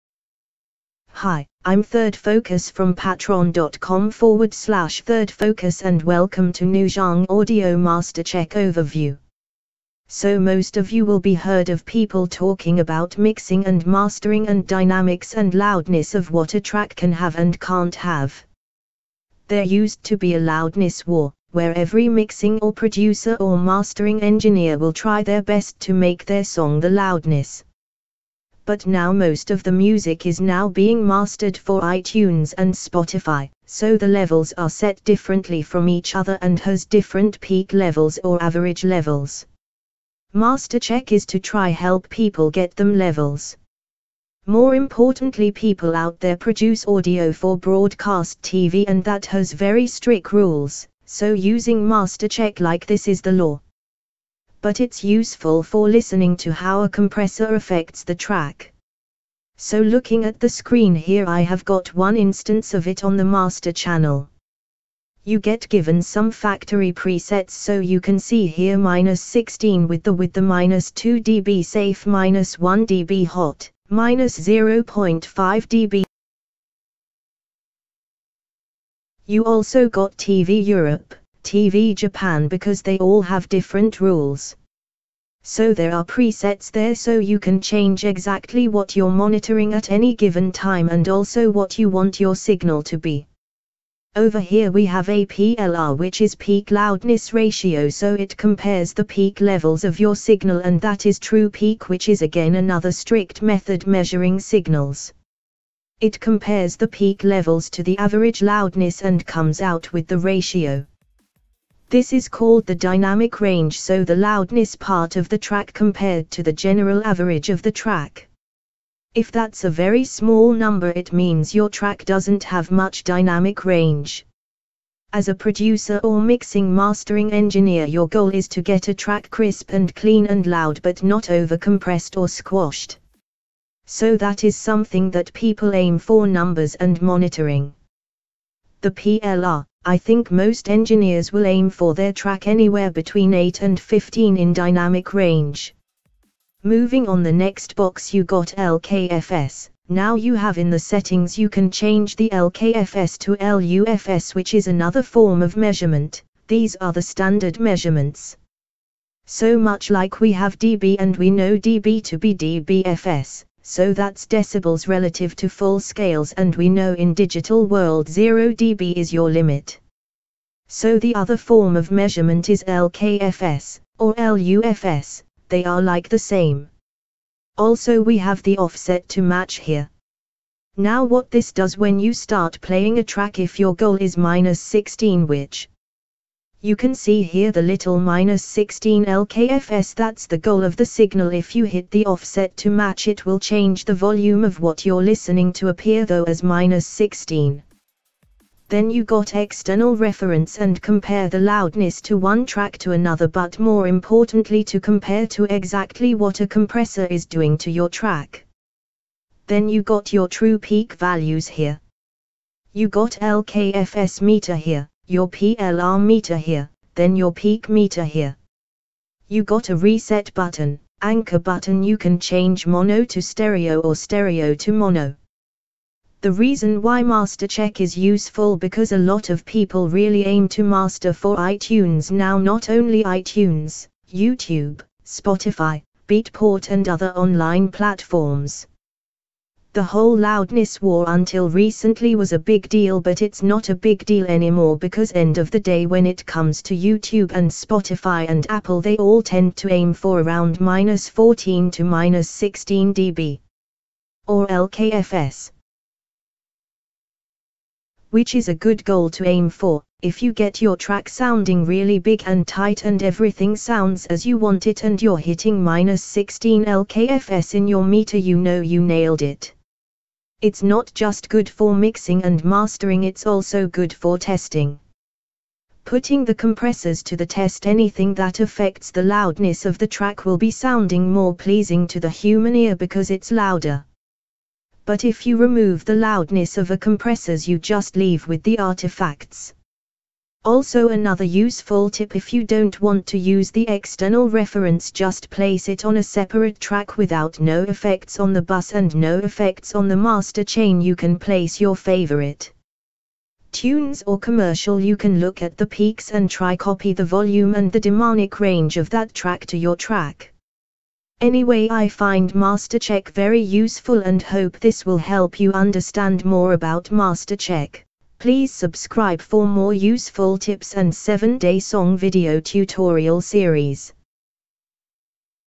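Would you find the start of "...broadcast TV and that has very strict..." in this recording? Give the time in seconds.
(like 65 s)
47 s.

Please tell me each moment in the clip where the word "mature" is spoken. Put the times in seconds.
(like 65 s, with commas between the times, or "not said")
not said.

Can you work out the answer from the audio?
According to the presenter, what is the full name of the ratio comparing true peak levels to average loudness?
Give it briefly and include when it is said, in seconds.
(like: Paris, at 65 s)
Peak loudness ratio, at 96 s.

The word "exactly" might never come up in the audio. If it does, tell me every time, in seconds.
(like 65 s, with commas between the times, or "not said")
88 s, 205 s.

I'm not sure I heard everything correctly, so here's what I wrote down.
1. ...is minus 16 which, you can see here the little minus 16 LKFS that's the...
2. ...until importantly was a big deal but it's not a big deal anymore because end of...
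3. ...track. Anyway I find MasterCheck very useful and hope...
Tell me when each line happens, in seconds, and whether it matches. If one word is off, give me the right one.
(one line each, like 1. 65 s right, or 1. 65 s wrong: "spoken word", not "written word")
1. 183 s right
2. 241 s wrong: "recently", not "importantly"
3. 309 s right.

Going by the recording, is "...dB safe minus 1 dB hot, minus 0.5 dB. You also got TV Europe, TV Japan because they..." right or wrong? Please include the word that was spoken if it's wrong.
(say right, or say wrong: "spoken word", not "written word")
right.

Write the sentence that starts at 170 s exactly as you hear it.
So the other form of measurement is LKFS, or LUFS, they are like the same.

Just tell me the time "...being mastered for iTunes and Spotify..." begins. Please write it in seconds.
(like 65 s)
30 s.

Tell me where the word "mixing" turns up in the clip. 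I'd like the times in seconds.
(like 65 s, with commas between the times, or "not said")
13 s, 22 s, 126 s, 271 s.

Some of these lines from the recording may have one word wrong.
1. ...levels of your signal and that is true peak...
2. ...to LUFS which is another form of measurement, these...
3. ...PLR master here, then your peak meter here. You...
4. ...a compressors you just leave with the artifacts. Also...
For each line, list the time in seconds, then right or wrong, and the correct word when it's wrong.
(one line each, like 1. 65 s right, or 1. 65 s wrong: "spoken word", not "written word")
1. 99 s right
2. 153 s right
3. 215 s wrong: "meter", not "master"
4. 286 s right.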